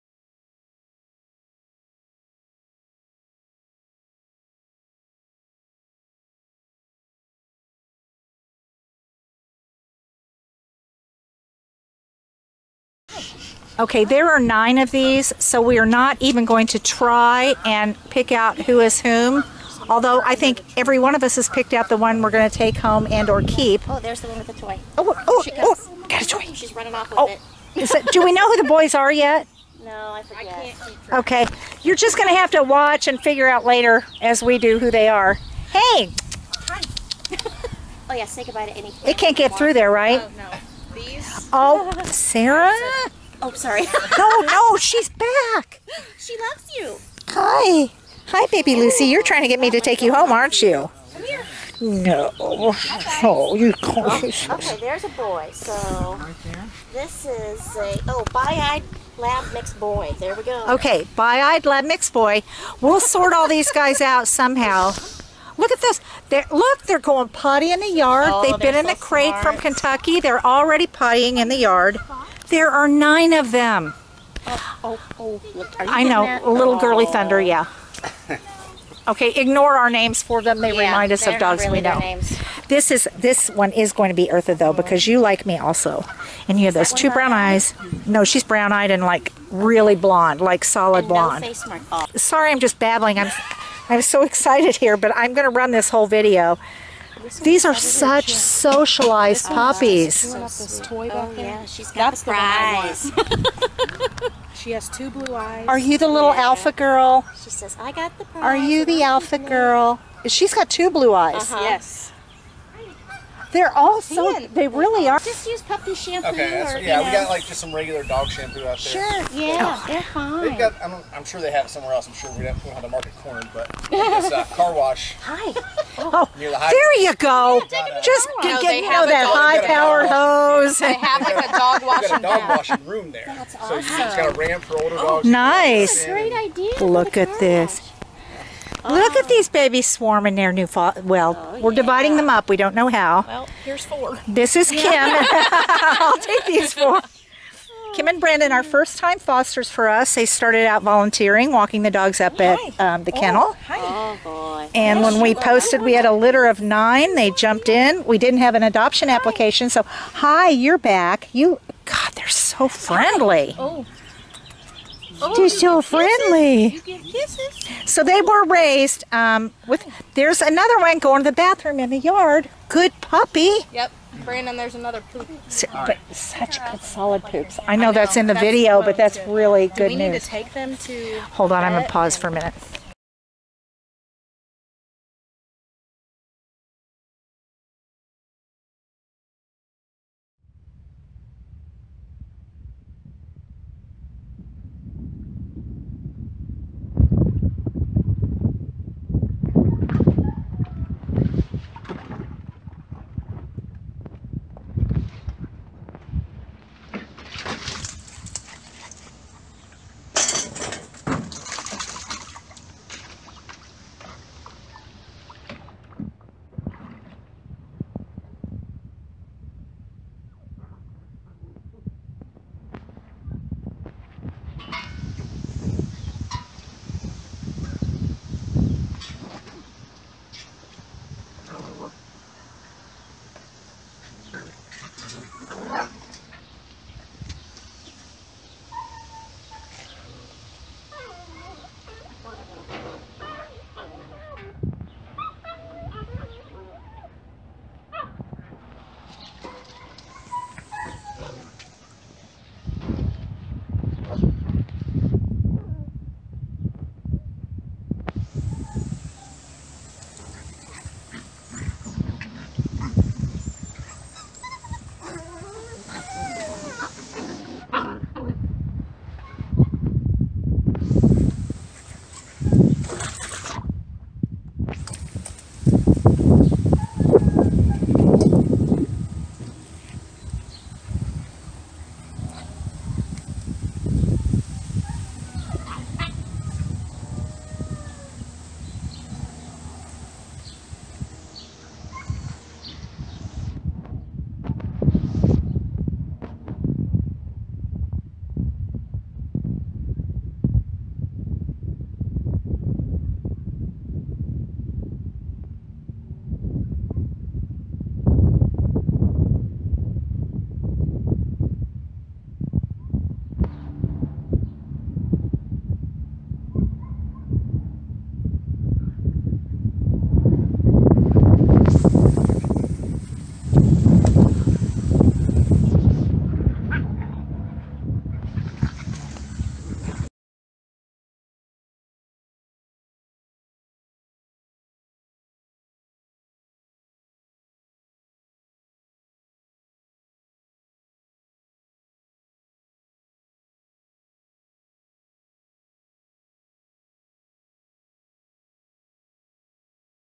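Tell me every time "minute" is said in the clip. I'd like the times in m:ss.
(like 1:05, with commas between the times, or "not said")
3:02.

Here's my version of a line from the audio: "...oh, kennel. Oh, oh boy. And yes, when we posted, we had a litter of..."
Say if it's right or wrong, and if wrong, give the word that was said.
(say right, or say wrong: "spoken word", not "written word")
right.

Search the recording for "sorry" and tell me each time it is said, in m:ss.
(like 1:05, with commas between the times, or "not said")
0:43, 1:32.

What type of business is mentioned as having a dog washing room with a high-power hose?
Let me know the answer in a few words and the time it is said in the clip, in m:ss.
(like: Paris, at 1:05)
Car wash, at 2:04.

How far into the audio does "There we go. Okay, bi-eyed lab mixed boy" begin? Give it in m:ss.
1:00.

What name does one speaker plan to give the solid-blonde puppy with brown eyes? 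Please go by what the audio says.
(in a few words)
Eartha.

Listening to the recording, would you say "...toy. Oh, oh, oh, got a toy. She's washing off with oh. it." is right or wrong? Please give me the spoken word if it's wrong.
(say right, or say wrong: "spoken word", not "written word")
wrong: "running", not "washing".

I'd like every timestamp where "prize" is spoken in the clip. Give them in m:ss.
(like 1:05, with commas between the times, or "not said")
1:42, 1:48.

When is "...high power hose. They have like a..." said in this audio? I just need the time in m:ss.
2:09.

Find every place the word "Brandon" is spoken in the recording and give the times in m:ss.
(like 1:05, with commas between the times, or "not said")
2:28, 2:54.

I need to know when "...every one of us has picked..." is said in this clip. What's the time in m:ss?
0:20.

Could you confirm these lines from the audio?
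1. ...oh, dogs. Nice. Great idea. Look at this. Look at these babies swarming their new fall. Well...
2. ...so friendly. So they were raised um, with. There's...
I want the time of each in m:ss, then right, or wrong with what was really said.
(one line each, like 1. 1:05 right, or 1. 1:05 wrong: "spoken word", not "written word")
1. 2:14 right
2. 2:45 right.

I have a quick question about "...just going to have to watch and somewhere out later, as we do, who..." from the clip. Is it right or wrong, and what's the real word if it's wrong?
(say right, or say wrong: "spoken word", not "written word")
wrong: "figure", not "somewhere".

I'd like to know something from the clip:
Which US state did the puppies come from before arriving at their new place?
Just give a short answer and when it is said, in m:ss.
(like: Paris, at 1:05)
Kentucky, at 1:09.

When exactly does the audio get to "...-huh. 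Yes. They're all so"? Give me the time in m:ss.
1:51.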